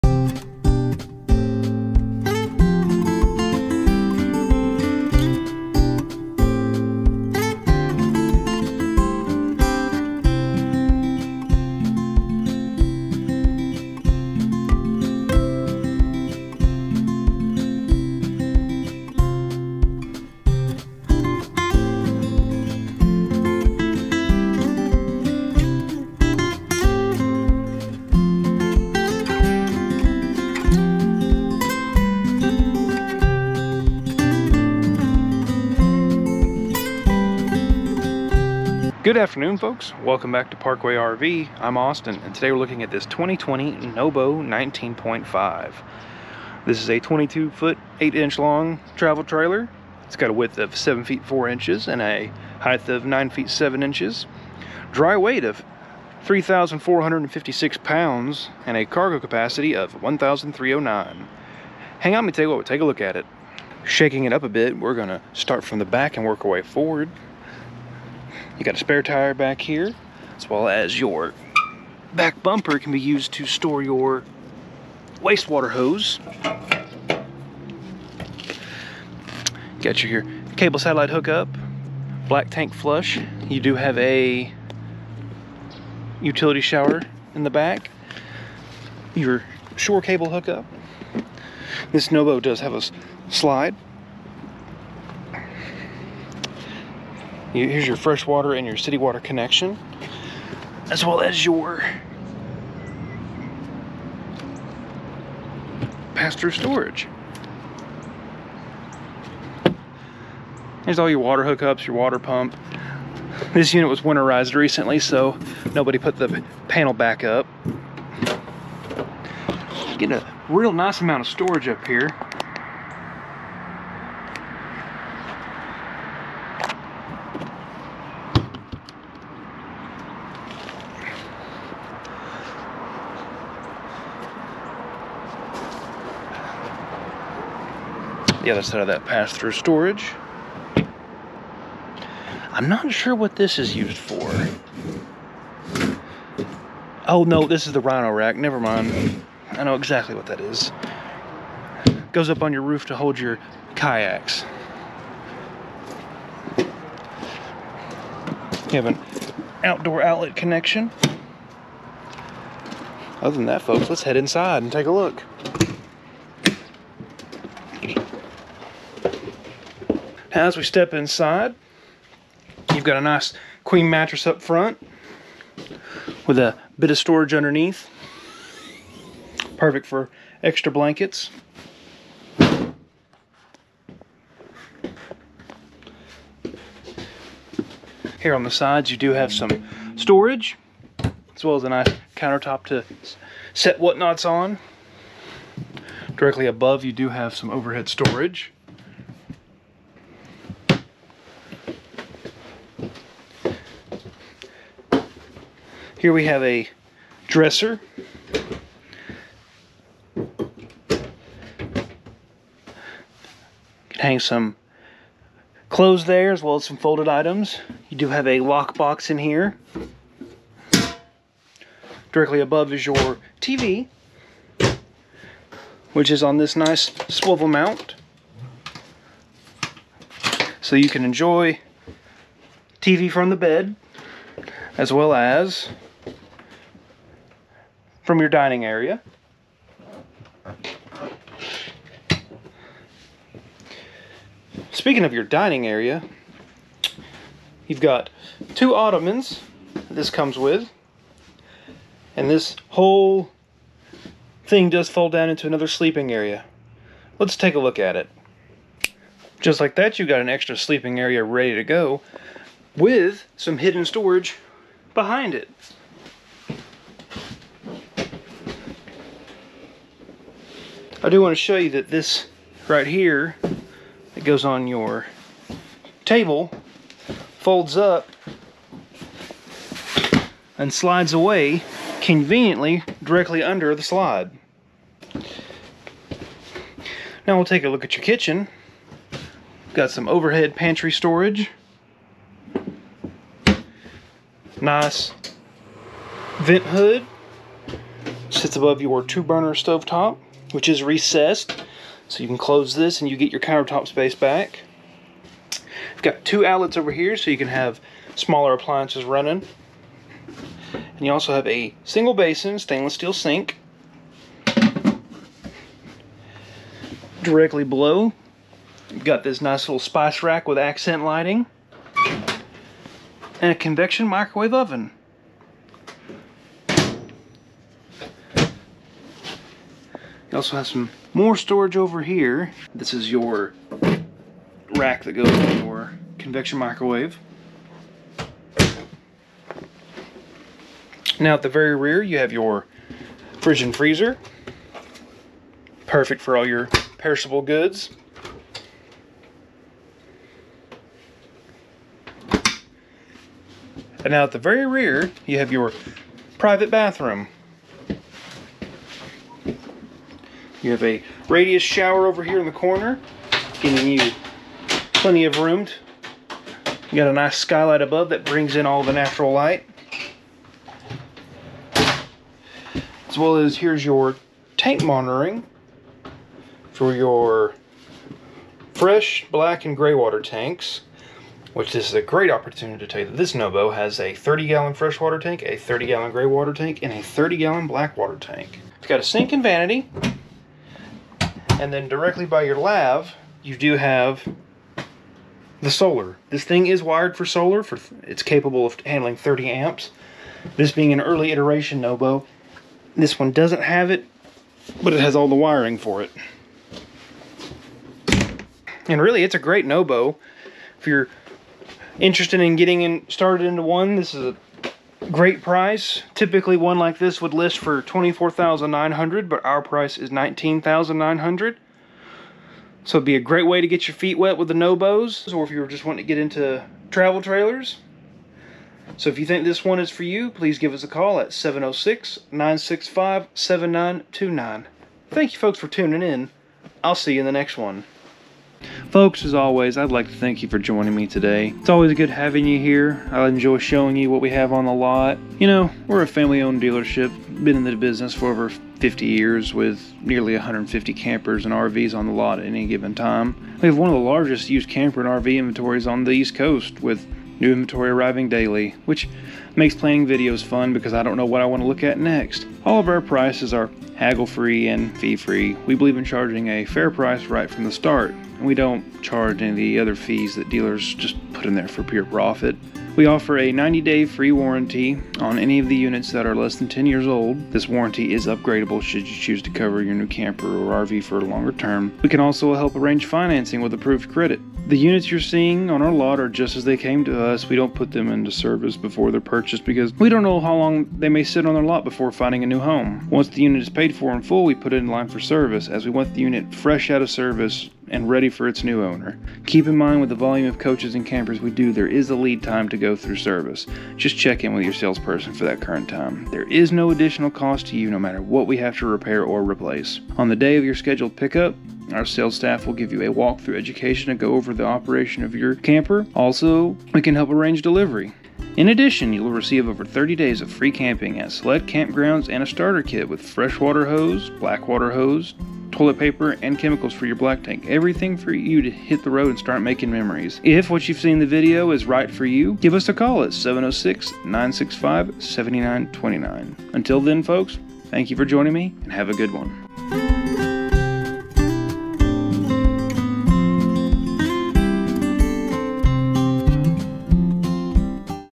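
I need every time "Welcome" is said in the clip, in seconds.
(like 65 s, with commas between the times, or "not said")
40 s.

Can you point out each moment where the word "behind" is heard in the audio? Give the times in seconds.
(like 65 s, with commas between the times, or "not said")
264 s.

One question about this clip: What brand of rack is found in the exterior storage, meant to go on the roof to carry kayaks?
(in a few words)
Rhino.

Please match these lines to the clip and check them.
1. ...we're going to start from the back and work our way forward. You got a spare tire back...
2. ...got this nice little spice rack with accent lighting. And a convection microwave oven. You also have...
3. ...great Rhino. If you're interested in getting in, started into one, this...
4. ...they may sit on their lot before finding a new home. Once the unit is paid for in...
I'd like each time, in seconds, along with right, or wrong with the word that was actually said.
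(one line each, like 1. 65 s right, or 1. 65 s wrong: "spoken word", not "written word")
1. 64 s right
2. 319 s right
3. 409 s wrong: "Nobo", not "Rhino"
4. 490 s right.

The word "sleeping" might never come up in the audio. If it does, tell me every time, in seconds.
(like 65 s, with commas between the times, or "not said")
255 s, 260 s.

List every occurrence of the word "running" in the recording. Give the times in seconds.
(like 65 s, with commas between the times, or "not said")
309 s.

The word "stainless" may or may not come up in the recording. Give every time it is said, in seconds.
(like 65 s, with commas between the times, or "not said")
312 s.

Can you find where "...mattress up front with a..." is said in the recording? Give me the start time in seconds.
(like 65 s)
173 s.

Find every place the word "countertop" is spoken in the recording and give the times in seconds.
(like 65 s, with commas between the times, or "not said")
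192 s, 303 s.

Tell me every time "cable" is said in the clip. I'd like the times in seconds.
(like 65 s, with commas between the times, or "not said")
80 s, 90 s.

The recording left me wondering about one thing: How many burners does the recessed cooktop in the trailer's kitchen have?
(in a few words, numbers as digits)
2.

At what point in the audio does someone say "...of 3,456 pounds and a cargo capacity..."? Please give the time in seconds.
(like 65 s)
55 s.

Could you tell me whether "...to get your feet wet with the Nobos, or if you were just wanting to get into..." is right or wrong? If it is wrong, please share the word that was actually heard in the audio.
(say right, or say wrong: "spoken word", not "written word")
right.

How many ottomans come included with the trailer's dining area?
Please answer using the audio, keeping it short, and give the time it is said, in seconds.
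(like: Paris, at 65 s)
2, at 248 s.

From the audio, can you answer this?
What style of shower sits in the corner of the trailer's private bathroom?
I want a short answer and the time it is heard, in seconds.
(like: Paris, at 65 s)
Radius shower, at 361 s.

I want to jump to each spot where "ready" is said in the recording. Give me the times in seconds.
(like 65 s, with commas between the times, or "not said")
261 s, 498 s.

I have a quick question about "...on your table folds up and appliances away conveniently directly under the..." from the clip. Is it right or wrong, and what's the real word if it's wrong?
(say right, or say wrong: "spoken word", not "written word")
wrong: "slides", not "appliances".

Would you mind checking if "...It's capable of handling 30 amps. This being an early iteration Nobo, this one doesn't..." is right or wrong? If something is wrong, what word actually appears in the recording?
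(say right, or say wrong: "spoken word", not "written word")
right.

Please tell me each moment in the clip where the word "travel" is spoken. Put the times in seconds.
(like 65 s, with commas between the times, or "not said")
48 s, 426 s.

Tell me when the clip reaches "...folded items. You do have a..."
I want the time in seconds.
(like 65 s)
216 s.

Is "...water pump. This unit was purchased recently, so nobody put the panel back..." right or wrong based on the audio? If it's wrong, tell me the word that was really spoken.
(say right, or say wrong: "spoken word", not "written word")
wrong: "winterized", not "purchased".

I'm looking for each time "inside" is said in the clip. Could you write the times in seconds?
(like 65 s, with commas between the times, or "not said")
164 s, 170 s.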